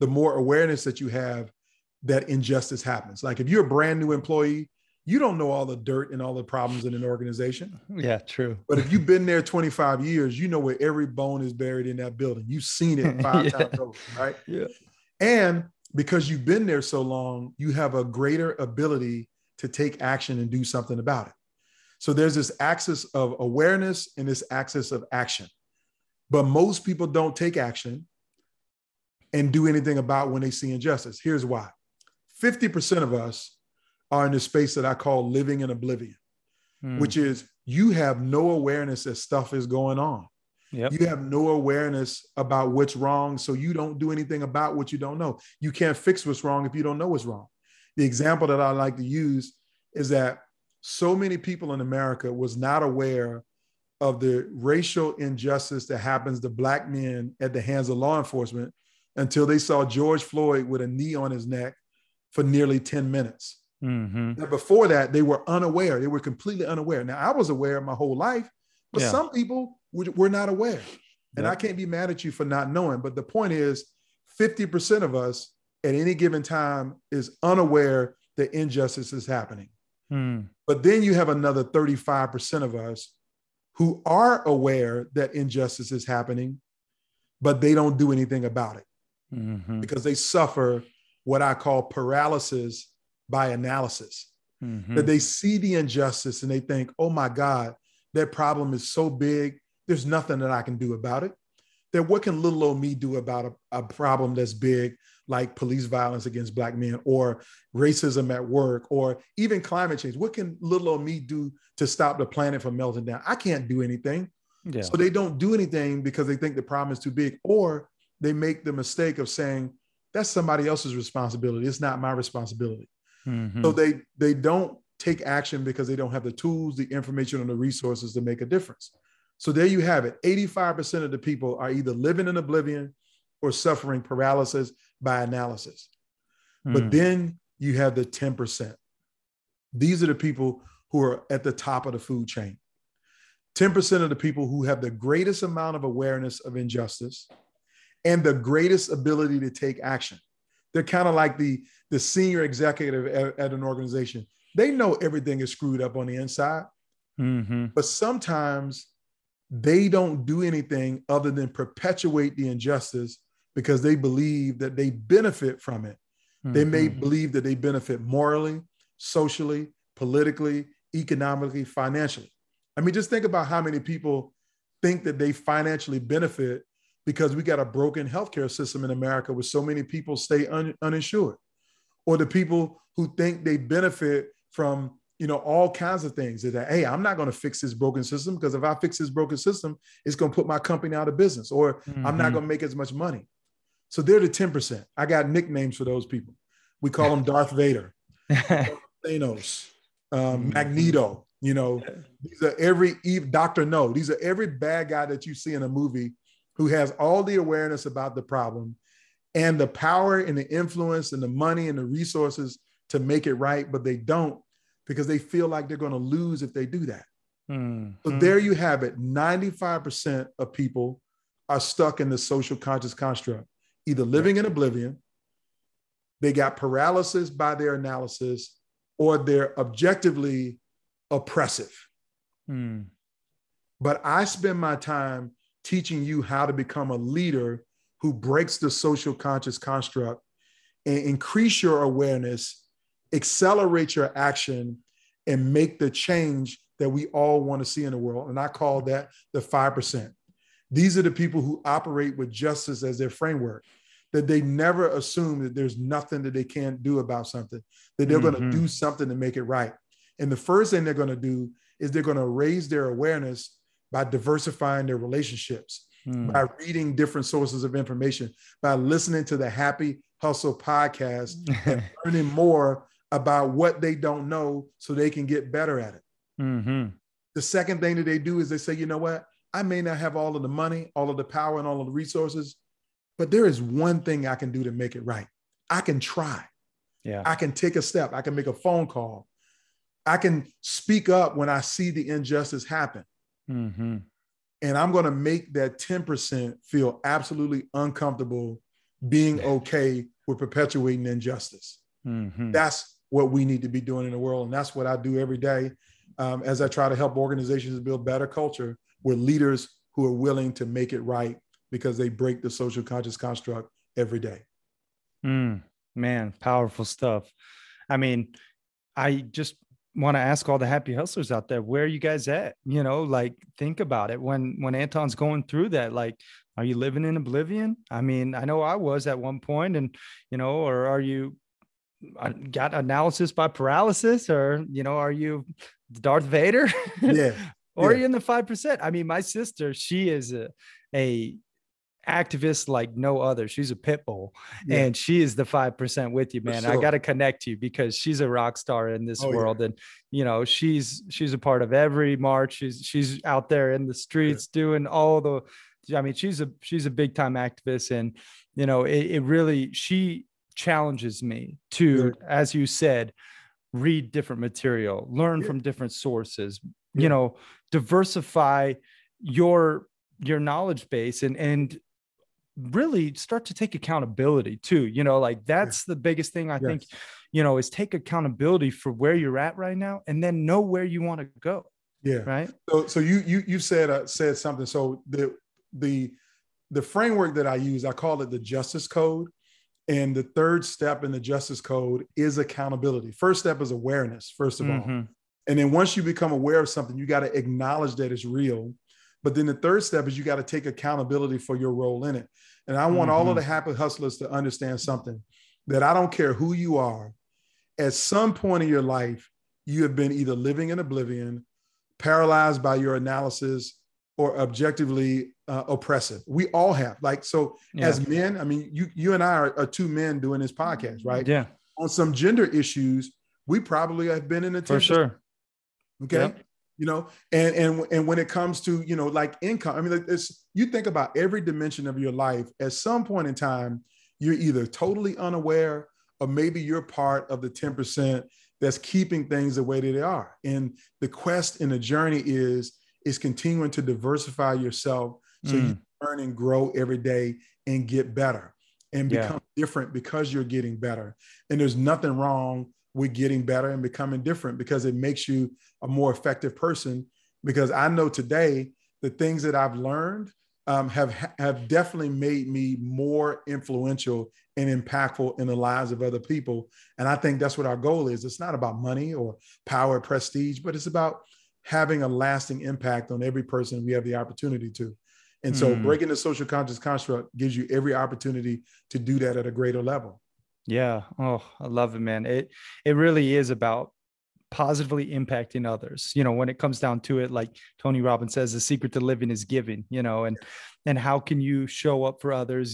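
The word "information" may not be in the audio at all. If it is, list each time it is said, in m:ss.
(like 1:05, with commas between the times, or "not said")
2:06, 4:27.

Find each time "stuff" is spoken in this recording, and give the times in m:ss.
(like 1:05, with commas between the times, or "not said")
0:39, 5:16.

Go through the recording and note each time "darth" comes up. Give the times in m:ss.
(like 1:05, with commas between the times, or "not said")
3:17, 5:35.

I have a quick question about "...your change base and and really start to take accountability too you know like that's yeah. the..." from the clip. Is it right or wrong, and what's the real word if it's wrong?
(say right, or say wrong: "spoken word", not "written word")
wrong: "knowledge", not "change".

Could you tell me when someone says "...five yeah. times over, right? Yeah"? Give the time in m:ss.
0:13.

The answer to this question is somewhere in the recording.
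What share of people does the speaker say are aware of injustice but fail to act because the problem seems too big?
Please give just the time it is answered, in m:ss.
1:21.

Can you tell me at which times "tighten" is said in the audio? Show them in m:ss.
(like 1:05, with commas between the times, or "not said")
not said.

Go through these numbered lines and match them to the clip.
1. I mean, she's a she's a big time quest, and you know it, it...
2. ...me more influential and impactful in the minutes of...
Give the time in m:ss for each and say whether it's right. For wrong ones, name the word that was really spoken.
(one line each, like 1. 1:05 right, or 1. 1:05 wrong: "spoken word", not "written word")
1. 5:55 wrong: "activist", not "quest"
2. 7:42 wrong: "lives", not "minutes".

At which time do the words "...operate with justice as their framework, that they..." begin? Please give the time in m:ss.
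4:11.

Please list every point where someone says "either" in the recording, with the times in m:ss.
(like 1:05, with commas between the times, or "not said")
2:11, 3:43, 6:50, 7:14.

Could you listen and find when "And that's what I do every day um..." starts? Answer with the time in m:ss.
5:04.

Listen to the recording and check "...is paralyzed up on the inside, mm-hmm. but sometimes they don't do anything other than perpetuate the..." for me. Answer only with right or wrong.
wrong.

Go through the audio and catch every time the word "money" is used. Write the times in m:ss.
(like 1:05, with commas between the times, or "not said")
3:12, 3:31, 4:40, 7:48.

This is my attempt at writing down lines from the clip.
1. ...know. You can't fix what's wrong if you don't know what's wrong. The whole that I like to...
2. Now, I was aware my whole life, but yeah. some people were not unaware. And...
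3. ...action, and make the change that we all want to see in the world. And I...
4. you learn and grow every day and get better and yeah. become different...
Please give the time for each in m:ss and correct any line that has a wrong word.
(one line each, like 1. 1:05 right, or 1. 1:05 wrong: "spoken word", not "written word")
1. 0:45 wrong: "example", not "whole"
2. 1:07 wrong: "aware", not "unaware"
3. 4:04 right
4. 7:25 right.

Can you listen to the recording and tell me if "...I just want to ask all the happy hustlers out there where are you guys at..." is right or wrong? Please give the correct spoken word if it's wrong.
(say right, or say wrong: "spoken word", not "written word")
right.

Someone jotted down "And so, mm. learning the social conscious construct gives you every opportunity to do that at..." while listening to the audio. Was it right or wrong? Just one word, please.
wrong.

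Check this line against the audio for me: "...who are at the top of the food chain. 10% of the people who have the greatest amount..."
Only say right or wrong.
right.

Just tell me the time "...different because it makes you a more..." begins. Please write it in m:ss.
7:34.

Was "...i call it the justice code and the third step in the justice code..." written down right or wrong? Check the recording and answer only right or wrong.
right.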